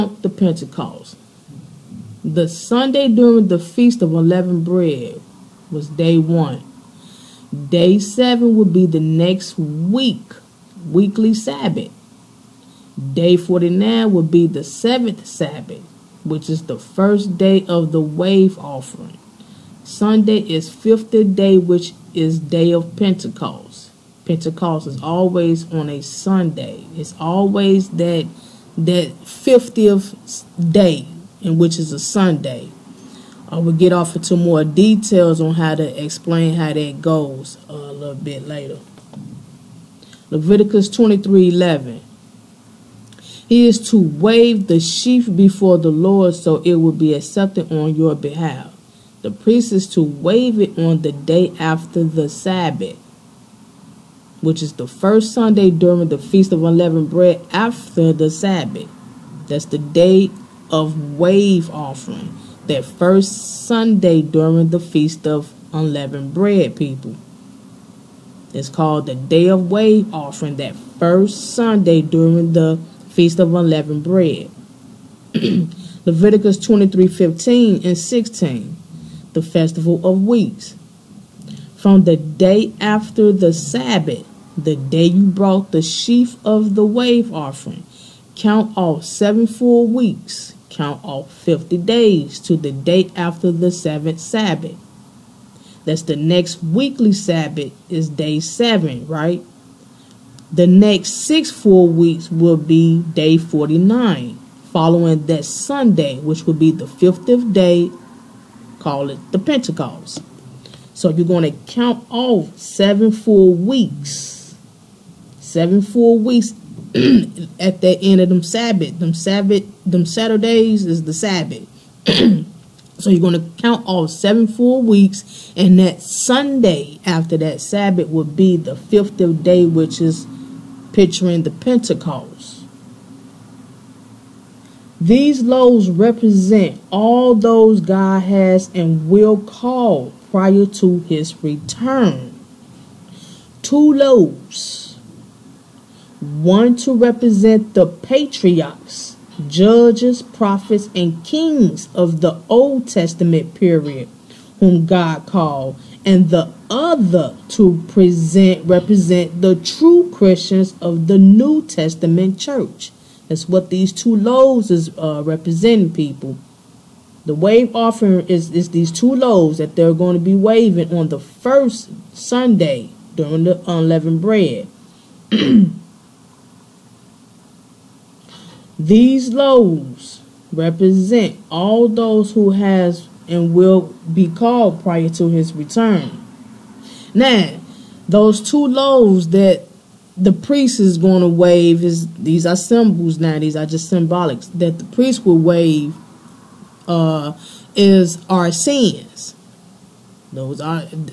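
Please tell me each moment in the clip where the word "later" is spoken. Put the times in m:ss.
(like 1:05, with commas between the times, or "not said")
0:38.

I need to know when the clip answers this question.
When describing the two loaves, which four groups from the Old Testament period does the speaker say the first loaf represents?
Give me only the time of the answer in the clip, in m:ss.
2:27.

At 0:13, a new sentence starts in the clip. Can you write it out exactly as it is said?
Day 49 would be the seventh Sabbath, which is the first day of the wave offering.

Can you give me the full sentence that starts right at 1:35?
That's the next weekly Sabbath is day seven, right?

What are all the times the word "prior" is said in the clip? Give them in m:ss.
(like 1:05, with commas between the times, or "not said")
2:20, 3:04.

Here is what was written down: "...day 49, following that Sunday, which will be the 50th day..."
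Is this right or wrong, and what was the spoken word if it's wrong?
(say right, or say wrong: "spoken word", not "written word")
right.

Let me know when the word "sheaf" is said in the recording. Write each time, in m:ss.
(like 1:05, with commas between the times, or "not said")
0:44, 1:25.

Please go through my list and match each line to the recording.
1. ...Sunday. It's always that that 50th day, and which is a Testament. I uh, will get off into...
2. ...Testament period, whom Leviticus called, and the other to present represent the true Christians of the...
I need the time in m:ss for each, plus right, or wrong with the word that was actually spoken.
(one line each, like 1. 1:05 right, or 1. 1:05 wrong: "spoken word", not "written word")
1. 0:26 wrong: "Sunday", not "Testament"
2. 2:32 wrong: "God", not "Leviticus".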